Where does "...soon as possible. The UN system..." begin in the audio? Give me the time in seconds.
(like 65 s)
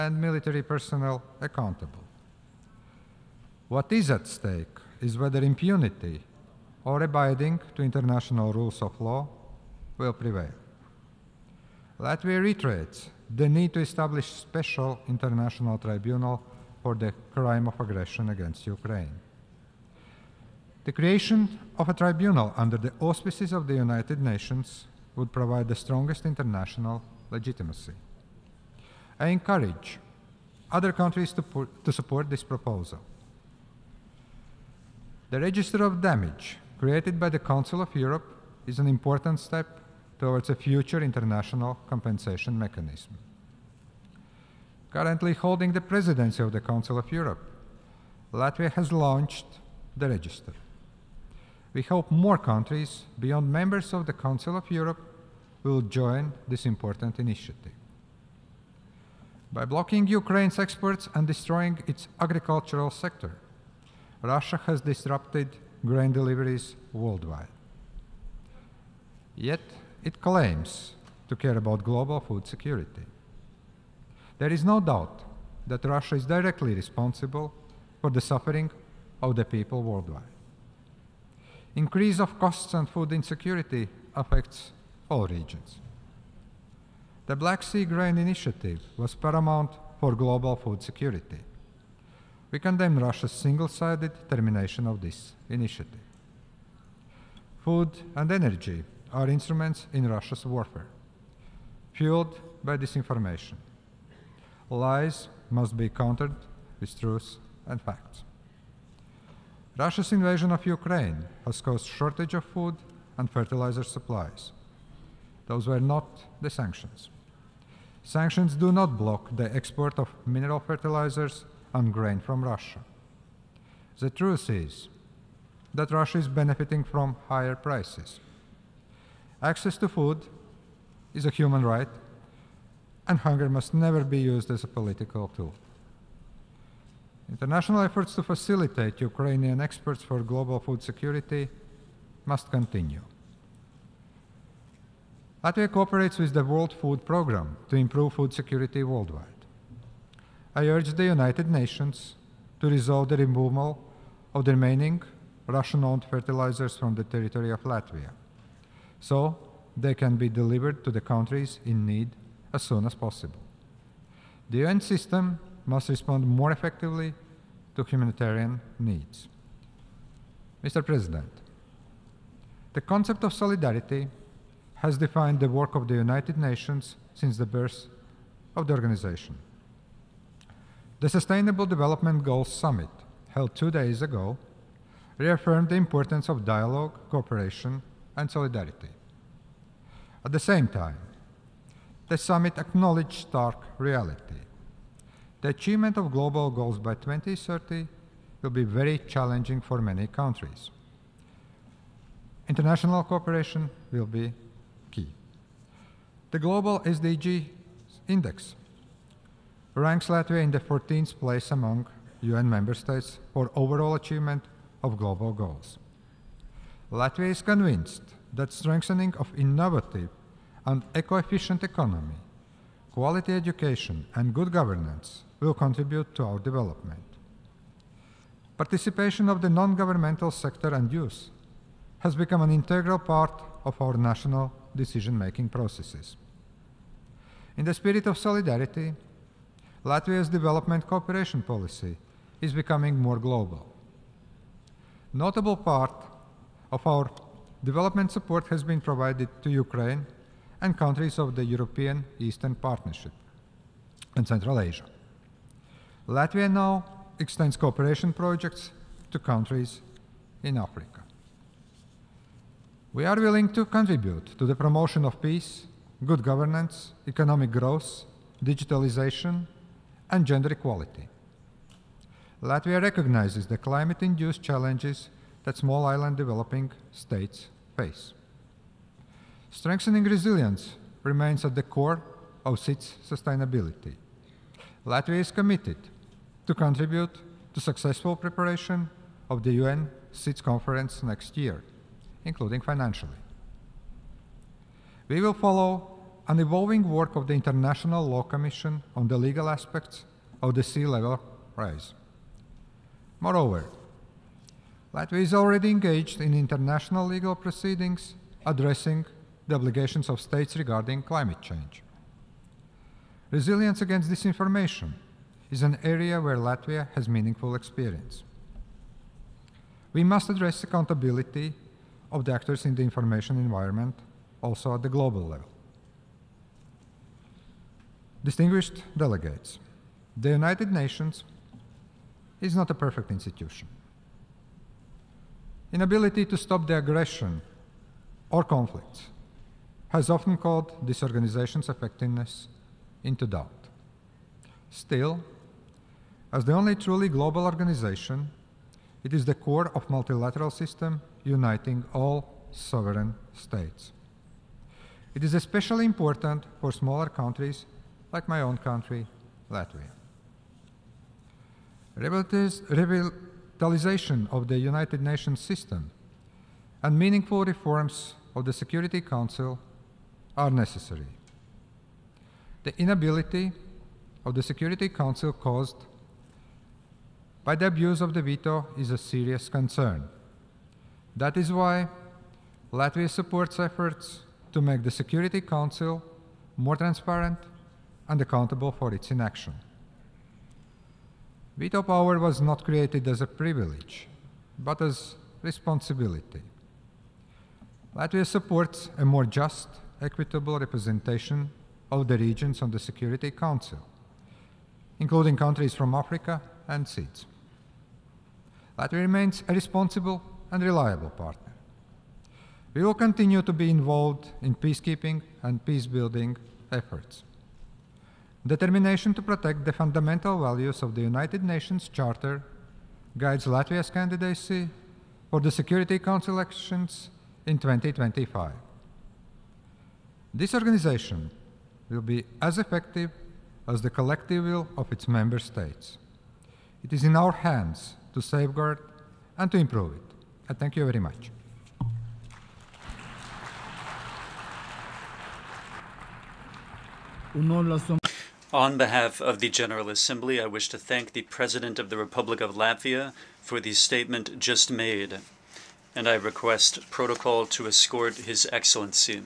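162 s.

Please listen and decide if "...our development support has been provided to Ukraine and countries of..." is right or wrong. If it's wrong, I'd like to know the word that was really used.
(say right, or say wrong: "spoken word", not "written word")
right.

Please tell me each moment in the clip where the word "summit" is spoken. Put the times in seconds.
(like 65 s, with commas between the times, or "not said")
182 s, 192 s.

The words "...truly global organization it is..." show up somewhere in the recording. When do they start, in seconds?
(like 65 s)
346 s.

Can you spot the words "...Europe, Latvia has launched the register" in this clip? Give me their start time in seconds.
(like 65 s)
47 s.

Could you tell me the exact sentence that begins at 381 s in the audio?
That is why Latvia supports efforts to make the Security Council more transparent and accountable for its inaction.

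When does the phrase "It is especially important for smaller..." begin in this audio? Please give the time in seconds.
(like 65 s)
355 s.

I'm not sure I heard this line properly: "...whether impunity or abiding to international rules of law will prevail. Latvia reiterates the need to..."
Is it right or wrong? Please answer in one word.
right.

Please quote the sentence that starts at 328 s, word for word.
Distinguished delegates, the United Nations is not a perfect institution.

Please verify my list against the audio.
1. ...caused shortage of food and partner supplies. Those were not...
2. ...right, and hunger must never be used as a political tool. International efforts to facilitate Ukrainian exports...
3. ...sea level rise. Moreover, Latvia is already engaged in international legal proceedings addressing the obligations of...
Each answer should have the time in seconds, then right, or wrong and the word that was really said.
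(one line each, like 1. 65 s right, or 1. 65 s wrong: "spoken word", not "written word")
1. 111 s wrong: "fertilizer", not "partner"
2. 131 s right
3. 300 s right.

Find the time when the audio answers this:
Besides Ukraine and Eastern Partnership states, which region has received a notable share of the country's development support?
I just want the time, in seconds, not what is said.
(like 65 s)
254 s.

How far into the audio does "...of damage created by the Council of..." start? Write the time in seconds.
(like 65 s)
35 s.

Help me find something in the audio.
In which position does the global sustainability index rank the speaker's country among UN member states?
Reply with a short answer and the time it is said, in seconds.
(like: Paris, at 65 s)
14th, at 210 s.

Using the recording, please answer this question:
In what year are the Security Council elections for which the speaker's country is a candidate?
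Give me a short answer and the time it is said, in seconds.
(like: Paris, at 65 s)
2025, at 427 s.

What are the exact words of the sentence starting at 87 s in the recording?
The Black Sea Grain Initiative was paramount for global food security.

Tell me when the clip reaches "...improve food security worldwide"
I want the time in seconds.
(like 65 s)
147 s.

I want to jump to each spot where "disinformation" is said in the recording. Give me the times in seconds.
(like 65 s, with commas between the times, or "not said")
102 s, 314 s.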